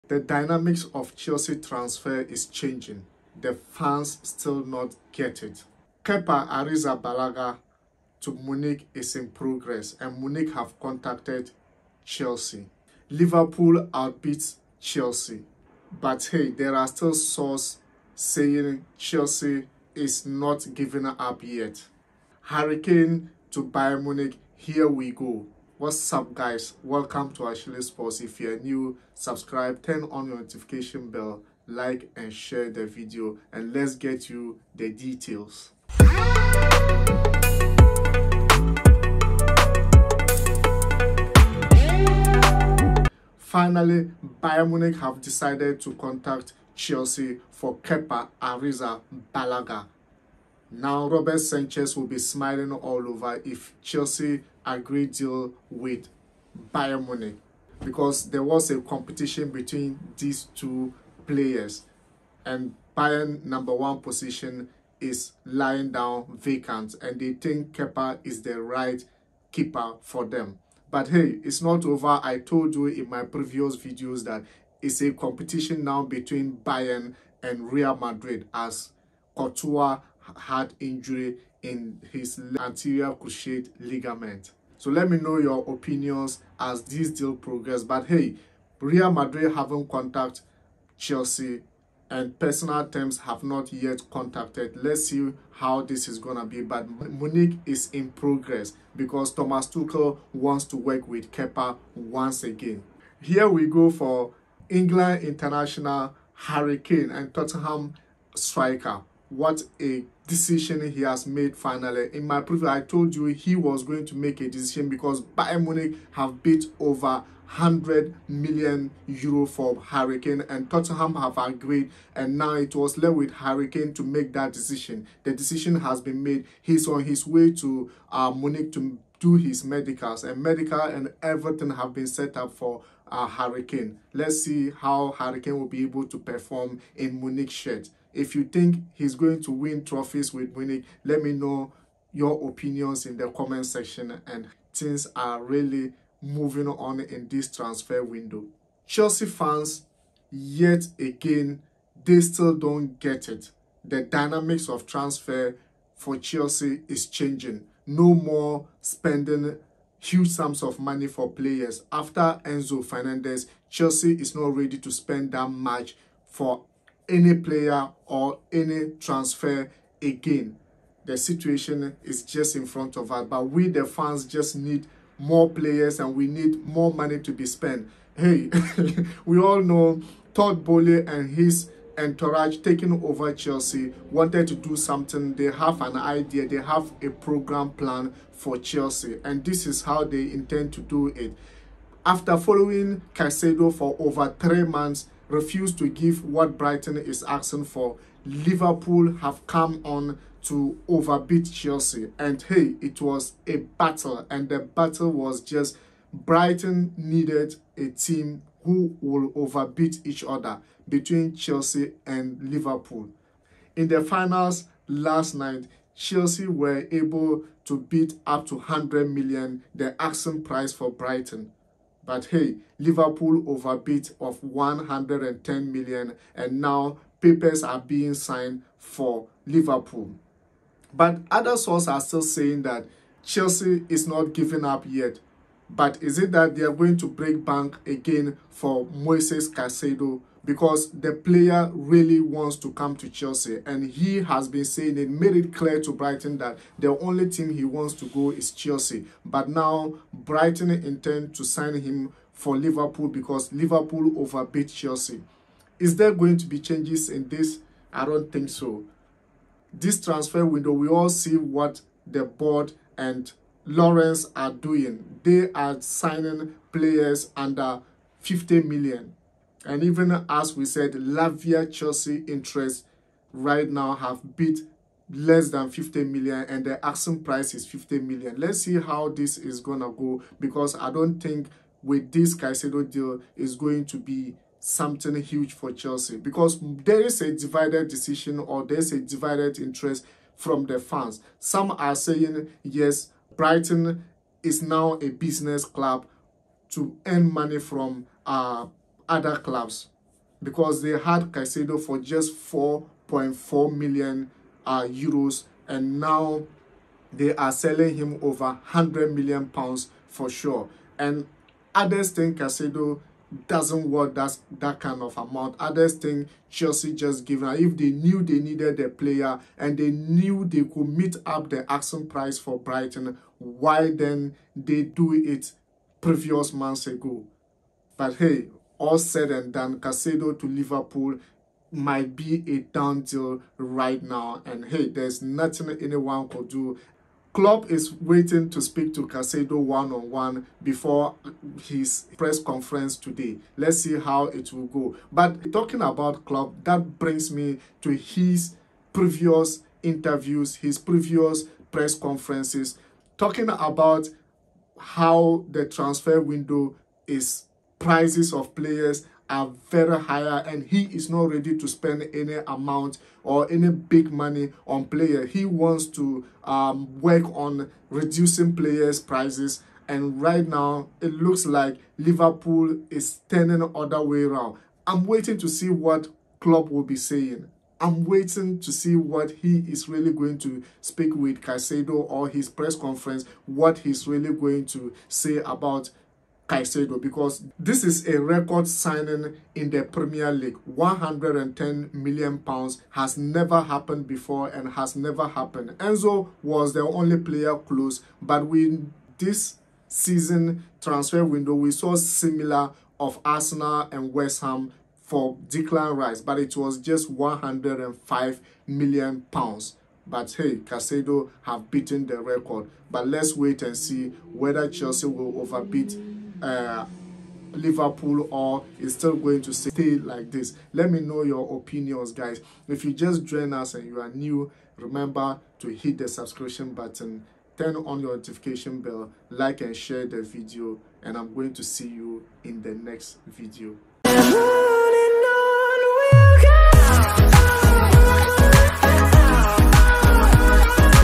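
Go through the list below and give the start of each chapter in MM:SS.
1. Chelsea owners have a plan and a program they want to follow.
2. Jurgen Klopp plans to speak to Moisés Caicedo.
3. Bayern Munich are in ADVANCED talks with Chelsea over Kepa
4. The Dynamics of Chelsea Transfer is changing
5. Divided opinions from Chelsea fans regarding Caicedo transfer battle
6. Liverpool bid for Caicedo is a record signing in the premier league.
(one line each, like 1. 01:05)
1. 02:58
2. 05:36
3. 00:42
4. 02:28
5. 04:46
6. 06:27.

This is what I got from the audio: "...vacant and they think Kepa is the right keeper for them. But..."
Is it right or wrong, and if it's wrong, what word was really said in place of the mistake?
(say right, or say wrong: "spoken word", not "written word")
right.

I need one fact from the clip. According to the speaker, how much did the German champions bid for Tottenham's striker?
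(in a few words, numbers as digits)
over 100 million euro.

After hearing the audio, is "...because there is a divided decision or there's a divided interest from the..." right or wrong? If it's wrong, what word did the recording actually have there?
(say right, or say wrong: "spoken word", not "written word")
right.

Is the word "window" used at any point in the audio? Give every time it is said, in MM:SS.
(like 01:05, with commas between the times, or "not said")
02:28, 04:20, 05:56, 06:41.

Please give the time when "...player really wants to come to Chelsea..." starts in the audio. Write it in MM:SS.
04:01.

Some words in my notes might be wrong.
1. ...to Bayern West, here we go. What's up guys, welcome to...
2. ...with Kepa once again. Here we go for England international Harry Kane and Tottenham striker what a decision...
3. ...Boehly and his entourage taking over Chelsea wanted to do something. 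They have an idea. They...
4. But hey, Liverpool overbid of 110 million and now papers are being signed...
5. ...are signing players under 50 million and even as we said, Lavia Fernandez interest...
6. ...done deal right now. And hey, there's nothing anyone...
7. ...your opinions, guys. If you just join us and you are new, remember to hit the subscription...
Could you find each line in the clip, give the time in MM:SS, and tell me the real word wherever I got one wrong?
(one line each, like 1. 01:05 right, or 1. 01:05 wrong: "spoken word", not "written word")
1. 00:23 wrong: "Munich", not "West"
2. 01:41 right
3. 03:00 right
4. 03:42 right
5. 04:25 wrong: "Chelsea", not "Fernandez"
6. 05:32 right
7. 07:01 right.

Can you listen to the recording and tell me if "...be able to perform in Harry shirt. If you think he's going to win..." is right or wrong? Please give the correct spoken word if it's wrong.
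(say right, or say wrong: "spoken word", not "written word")
wrong: "Munich", not "Harry".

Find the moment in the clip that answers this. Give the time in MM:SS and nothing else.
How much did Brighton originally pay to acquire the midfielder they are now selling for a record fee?
05:02.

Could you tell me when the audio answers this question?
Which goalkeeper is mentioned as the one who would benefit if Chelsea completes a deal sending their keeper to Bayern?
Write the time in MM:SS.
00:51.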